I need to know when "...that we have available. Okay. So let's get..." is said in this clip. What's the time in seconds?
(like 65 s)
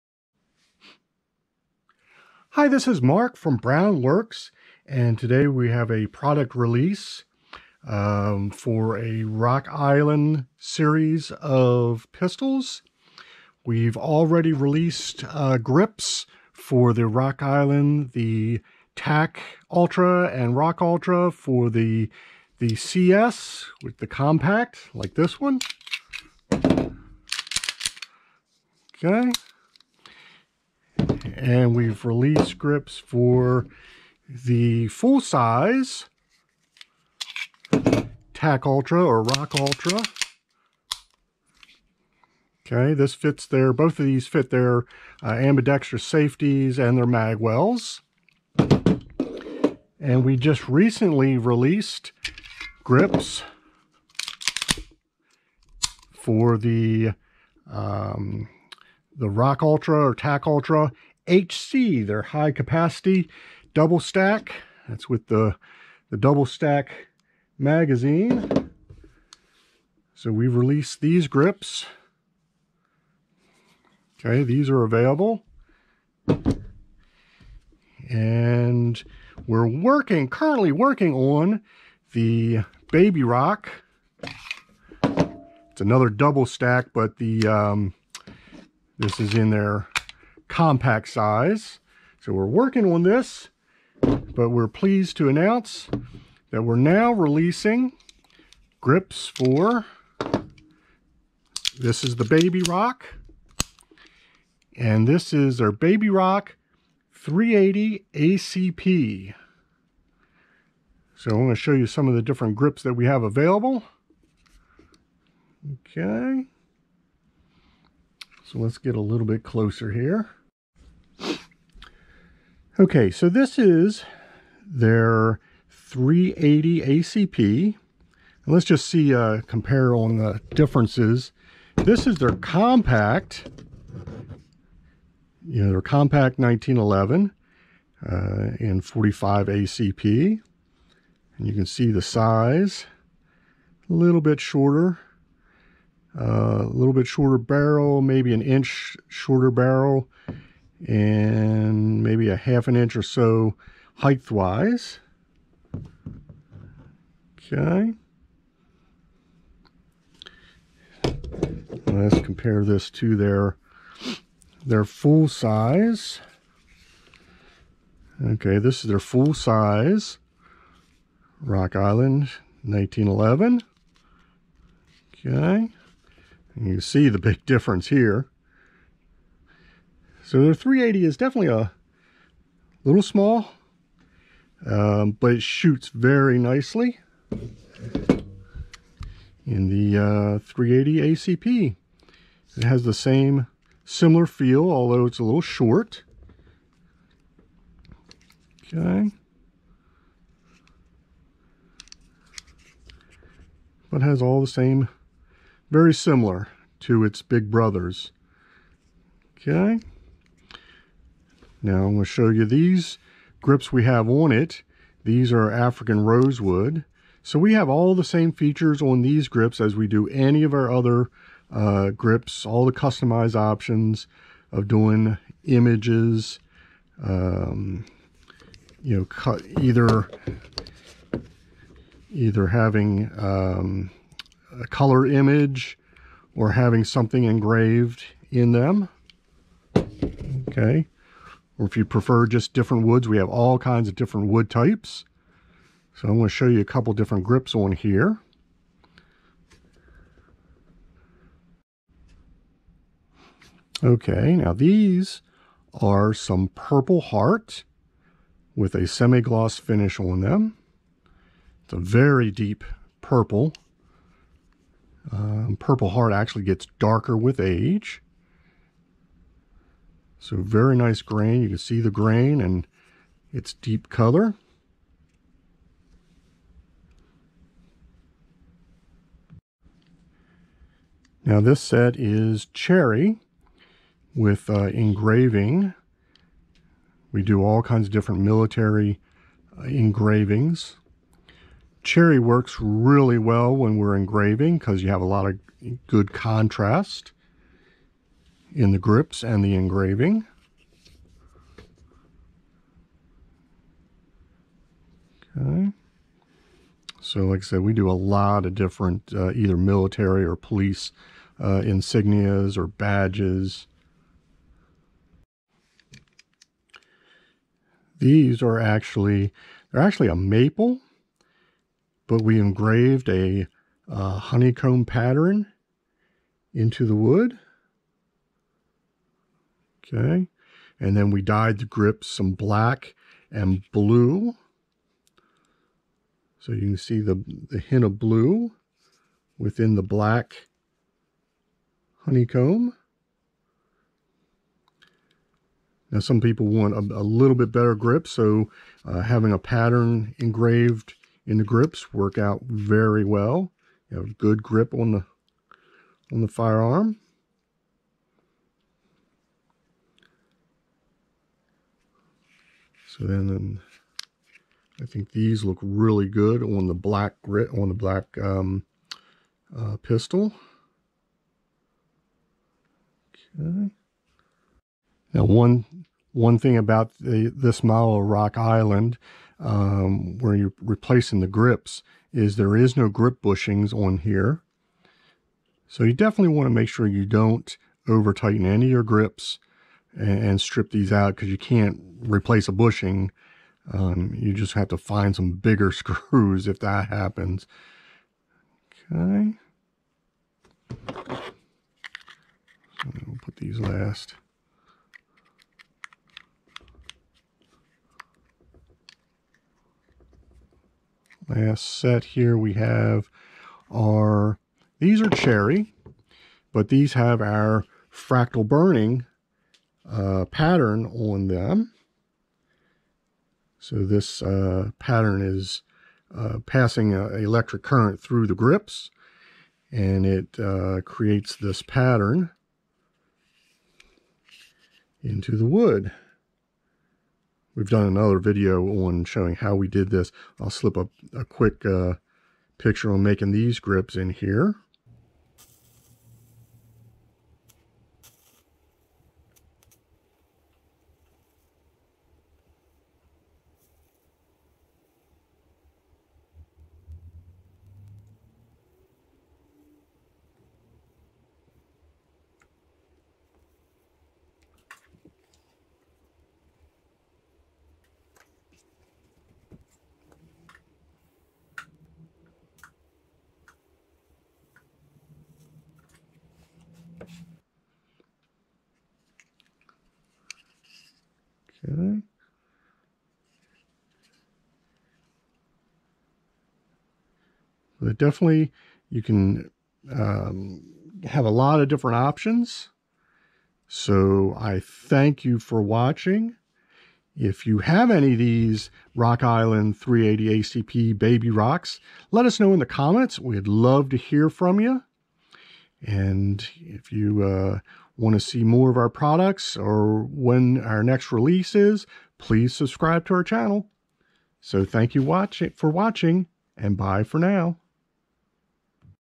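112 s.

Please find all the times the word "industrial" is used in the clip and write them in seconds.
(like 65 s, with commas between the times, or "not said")
not said.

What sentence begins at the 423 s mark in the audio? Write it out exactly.
So this uh, pattern is uh, passing an electric current through the grips and it uh, creates this pattern into the wood.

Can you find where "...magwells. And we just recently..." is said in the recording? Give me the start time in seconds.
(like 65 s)
47 s.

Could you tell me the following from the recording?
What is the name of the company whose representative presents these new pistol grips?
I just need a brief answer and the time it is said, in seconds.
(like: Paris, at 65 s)
BrowneWorks, at 3 s.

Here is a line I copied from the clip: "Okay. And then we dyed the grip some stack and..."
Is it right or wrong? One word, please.
wrong.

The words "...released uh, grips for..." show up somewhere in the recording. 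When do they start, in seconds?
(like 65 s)
14 s.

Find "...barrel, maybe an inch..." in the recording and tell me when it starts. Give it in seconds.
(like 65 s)
147 s.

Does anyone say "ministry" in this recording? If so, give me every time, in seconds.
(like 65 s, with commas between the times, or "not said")
not said.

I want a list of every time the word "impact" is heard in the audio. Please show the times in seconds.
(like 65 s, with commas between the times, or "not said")
not said.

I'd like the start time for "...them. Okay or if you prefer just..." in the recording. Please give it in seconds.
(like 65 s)
238 s.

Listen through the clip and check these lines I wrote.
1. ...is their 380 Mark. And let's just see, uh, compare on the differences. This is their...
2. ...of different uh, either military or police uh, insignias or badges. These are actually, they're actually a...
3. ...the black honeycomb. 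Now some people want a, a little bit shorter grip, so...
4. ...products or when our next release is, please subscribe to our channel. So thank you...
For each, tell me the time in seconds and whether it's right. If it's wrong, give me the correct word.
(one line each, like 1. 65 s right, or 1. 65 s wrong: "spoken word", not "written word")
1. 123 s wrong: "ACP", not "Mark"
2. 308 s right
3. 339 s wrong: "better", not "shorter"
4. 508 s right.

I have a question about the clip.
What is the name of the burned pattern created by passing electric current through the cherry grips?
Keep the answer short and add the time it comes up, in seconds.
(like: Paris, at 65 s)
fractal burning, at 417 s.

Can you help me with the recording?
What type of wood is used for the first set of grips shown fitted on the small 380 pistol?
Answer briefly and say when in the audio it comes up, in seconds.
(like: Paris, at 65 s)
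African rosewood, at 215 s.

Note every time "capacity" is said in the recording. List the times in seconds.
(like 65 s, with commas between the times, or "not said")
62 s.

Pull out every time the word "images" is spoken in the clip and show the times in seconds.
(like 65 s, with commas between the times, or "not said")
225 s, 235 s.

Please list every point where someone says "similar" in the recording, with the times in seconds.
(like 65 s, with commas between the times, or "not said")
193 s, 205 s.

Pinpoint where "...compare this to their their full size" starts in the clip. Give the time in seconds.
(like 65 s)
162 s.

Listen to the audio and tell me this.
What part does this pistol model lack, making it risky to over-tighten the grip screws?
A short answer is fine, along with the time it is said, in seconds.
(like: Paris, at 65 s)
grip bushings, at 382 s.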